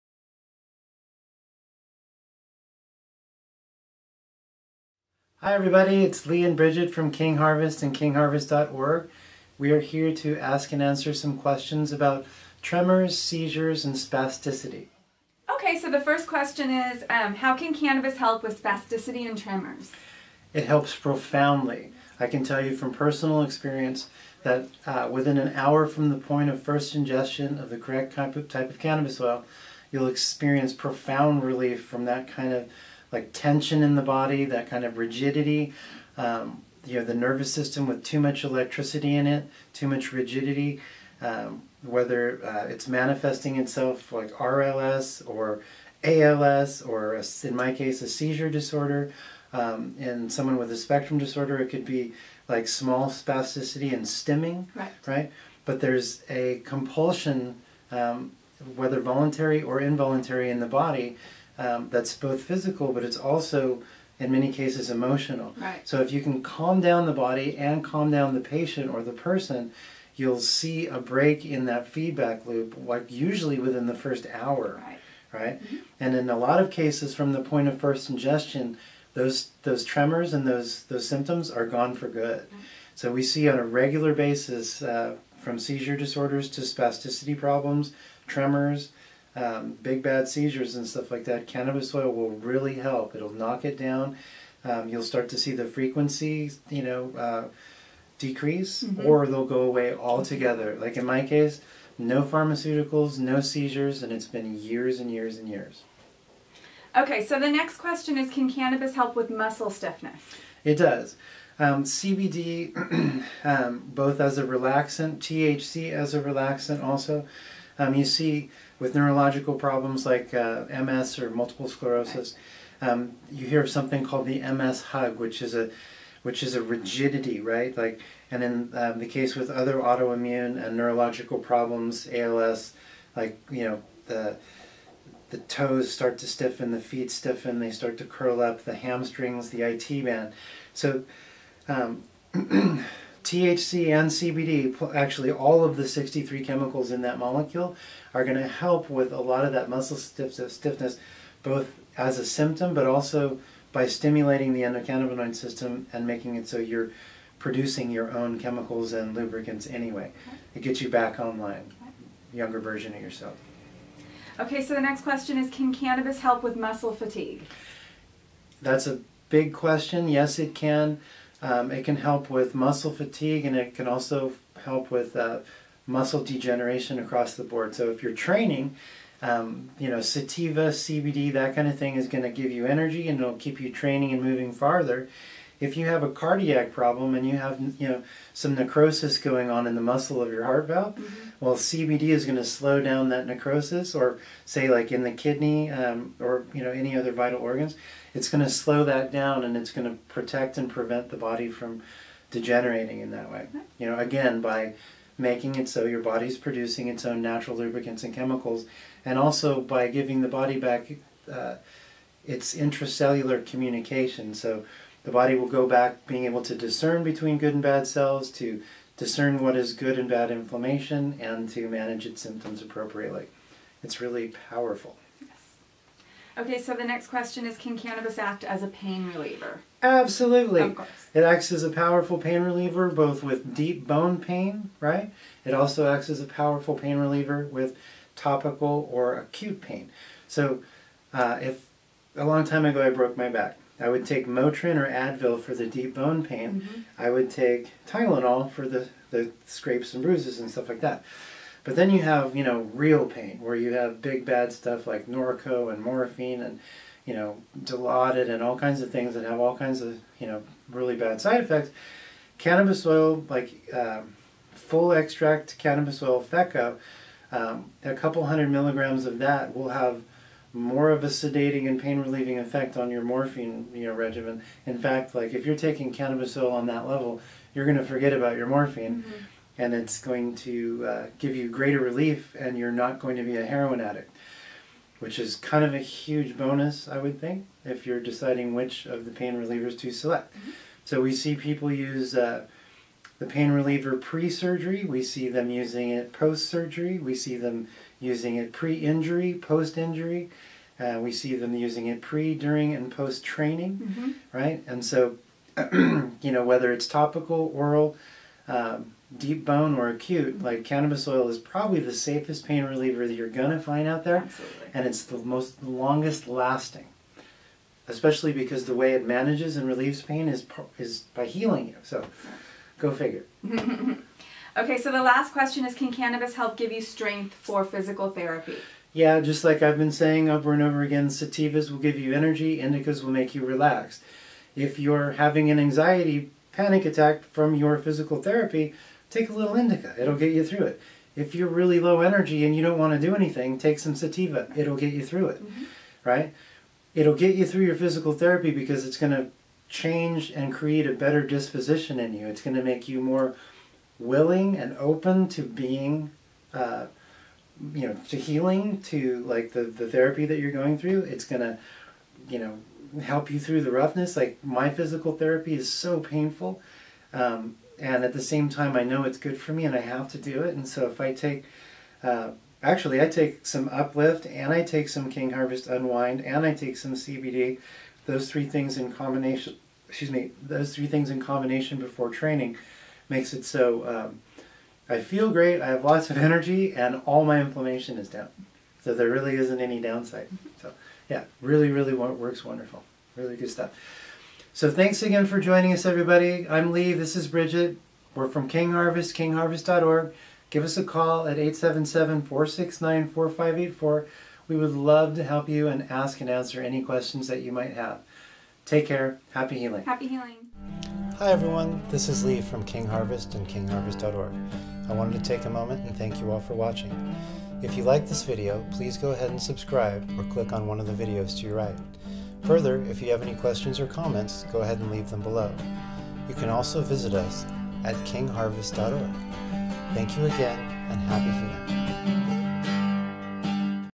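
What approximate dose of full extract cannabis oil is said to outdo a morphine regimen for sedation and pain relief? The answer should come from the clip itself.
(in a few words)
A couple hundred milligrams.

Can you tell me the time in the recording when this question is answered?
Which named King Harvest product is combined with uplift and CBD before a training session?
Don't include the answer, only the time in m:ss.
6:15.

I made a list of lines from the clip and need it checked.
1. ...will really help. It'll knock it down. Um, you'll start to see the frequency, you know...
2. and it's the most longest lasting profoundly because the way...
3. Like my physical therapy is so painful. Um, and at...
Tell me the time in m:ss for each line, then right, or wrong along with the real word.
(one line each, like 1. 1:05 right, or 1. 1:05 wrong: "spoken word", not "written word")
1. 1:32 right
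2. 5:14 wrong: "especially", not "profoundly"
3. 6:04 right.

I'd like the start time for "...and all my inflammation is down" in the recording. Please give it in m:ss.
6:26.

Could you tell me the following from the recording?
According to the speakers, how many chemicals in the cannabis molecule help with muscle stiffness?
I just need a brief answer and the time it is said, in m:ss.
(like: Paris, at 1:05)
63, at 2:25.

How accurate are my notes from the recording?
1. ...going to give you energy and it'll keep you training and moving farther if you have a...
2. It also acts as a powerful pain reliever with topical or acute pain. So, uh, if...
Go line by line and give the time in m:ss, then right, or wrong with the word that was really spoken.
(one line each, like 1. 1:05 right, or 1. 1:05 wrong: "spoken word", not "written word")
1. 3:02 right
2. 3:55 right.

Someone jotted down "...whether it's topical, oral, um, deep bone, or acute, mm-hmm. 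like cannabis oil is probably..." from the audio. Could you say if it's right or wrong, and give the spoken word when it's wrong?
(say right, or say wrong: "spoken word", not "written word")
right.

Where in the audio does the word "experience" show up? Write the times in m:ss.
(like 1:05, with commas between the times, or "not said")
0:23, 0:30.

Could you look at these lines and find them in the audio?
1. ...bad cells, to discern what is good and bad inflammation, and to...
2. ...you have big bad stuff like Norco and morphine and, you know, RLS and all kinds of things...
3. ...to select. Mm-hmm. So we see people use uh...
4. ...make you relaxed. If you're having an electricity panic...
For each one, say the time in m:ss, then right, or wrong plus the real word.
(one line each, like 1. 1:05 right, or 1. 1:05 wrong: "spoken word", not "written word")
1. 3:37 right
2. 4:13 wrong: "Dilaudid", not "RLS"
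3. 4:49 right
4. 5:33 wrong: "anxiety", not "electricity".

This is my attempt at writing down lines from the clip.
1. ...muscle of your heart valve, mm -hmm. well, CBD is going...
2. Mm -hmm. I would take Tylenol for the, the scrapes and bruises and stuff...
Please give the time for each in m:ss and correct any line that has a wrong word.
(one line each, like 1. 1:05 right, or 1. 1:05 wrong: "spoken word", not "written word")
1. 3:09 right
2. 4:06 right.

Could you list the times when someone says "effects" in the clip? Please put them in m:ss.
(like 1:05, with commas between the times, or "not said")
4:21, 4:32.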